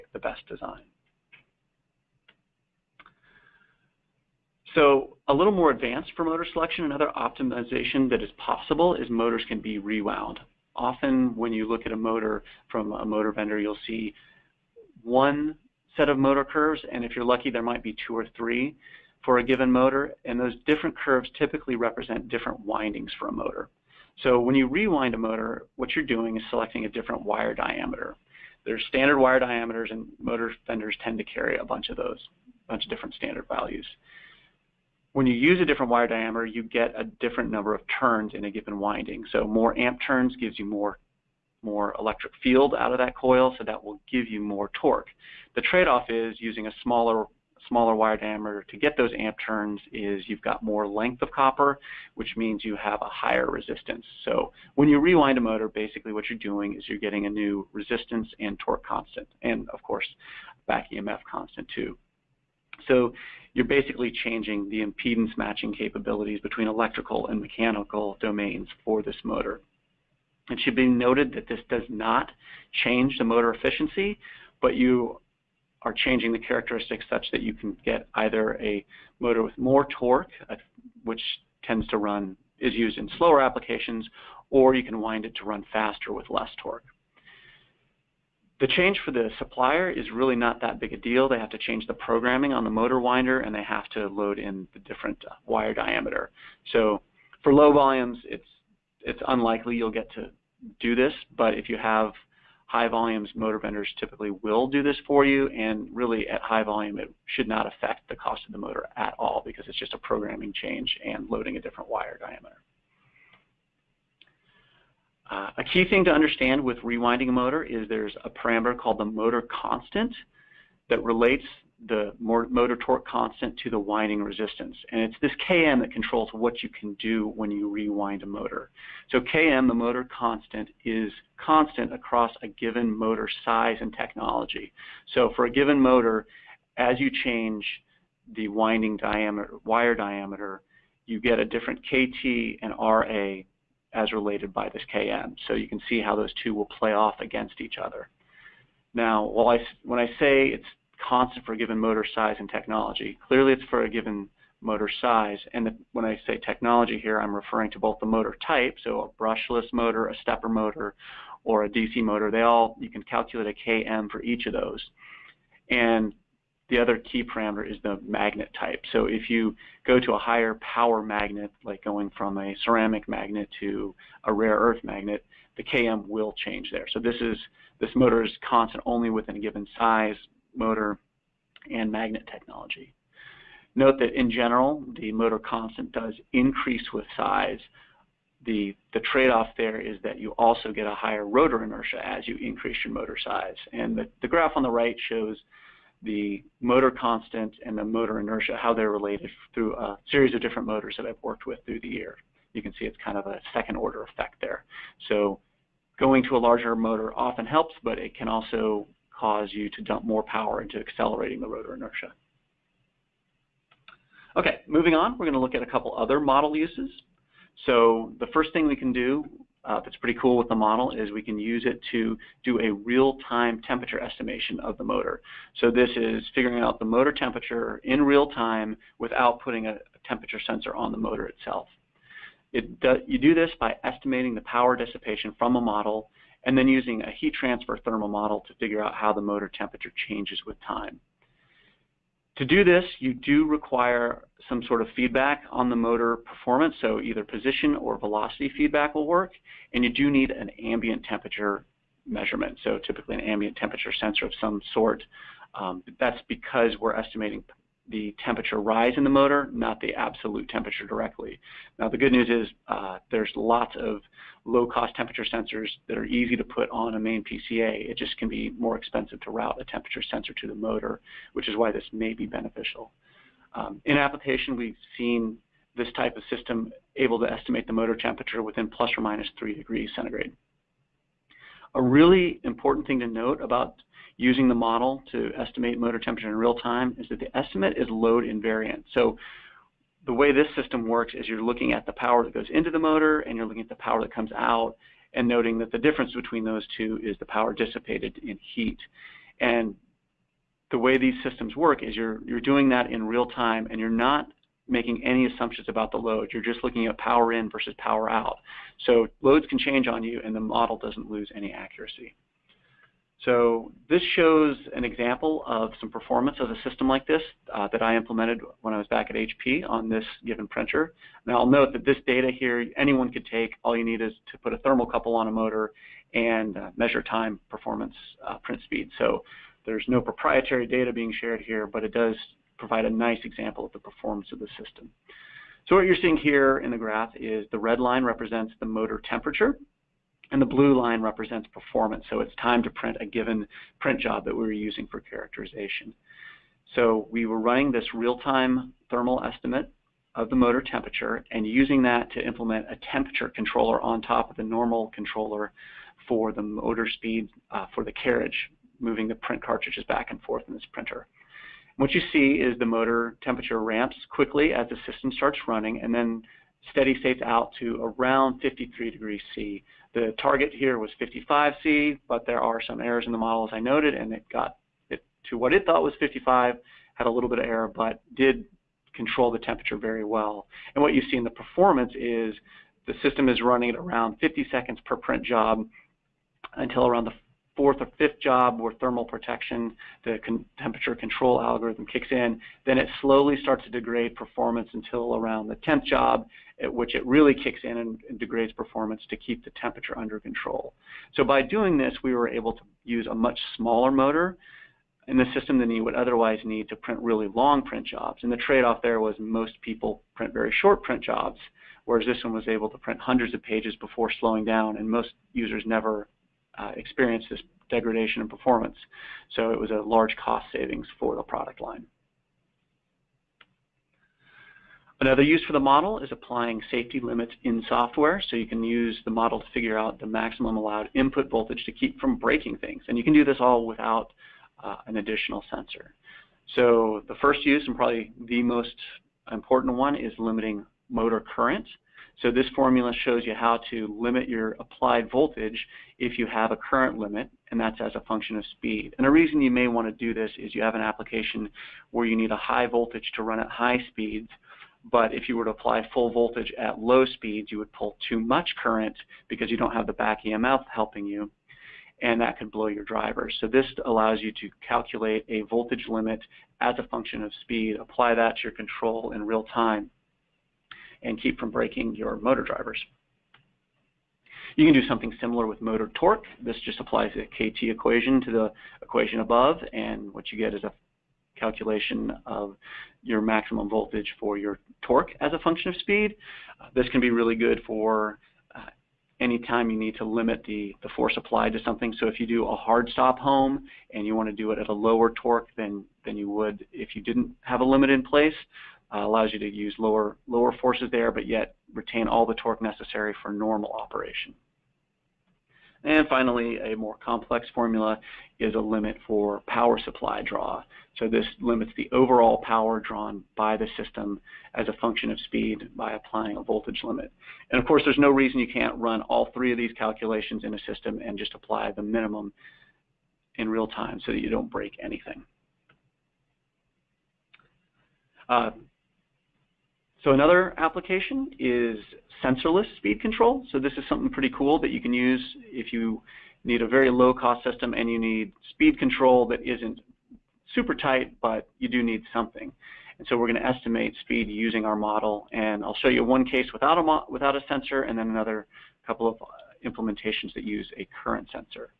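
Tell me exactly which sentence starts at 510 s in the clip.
So this limits the overall power drawn by the system as a function of speed by applying a voltage limit.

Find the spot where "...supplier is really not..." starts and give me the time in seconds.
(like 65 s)
89 s.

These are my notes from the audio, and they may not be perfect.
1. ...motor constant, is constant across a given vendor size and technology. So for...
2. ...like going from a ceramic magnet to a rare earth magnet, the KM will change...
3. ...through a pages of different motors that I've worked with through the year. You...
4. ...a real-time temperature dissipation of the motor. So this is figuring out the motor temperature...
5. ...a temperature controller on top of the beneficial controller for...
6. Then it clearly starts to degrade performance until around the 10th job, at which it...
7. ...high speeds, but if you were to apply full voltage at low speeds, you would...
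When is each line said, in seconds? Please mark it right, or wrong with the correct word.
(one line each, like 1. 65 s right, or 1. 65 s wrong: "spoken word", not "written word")
1. 129 s wrong: "motor", not "vendor"
2. 171 s right
3. 199 s wrong: "series", not "pages"
4. 222 s wrong: "estimation", not "dissipation"
5. 352 s wrong: "normal", not "beneficial"
6. 392 s wrong: "slowly", not "clearly"
7. 453 s right.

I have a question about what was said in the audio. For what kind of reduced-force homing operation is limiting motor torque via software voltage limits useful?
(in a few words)
Hard stop home.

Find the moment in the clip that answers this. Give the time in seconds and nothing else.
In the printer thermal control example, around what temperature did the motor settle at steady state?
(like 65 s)
368 s.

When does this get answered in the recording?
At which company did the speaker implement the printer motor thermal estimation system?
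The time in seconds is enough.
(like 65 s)
319 s.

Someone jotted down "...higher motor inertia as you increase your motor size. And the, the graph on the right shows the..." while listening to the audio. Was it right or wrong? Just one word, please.
wrong.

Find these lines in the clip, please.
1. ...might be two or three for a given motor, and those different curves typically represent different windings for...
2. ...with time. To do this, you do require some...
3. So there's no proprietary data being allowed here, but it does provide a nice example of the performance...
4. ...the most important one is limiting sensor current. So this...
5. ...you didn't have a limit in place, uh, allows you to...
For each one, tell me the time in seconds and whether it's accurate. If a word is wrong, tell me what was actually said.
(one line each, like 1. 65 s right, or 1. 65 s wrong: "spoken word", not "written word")
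1. 17 s right
2. 240 s right
3. 328 s wrong: "shared", not "allowed"
4. 438 s wrong: "motor", not "sensor"
5. 496 s right.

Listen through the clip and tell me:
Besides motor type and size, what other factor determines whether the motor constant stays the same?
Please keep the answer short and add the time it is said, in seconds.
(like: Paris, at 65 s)
Magnet type, at 168 s.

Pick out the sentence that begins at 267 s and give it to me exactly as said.
It just can be more expensive to route a temperature sensor to the motor, which is why this may be beneficial.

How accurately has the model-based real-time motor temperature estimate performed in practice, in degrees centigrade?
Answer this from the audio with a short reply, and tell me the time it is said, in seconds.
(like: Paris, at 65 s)
±3 degrees, at 278 s.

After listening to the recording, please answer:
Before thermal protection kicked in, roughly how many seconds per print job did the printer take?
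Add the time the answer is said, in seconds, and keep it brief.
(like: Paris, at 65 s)
50 seconds, at 384 s.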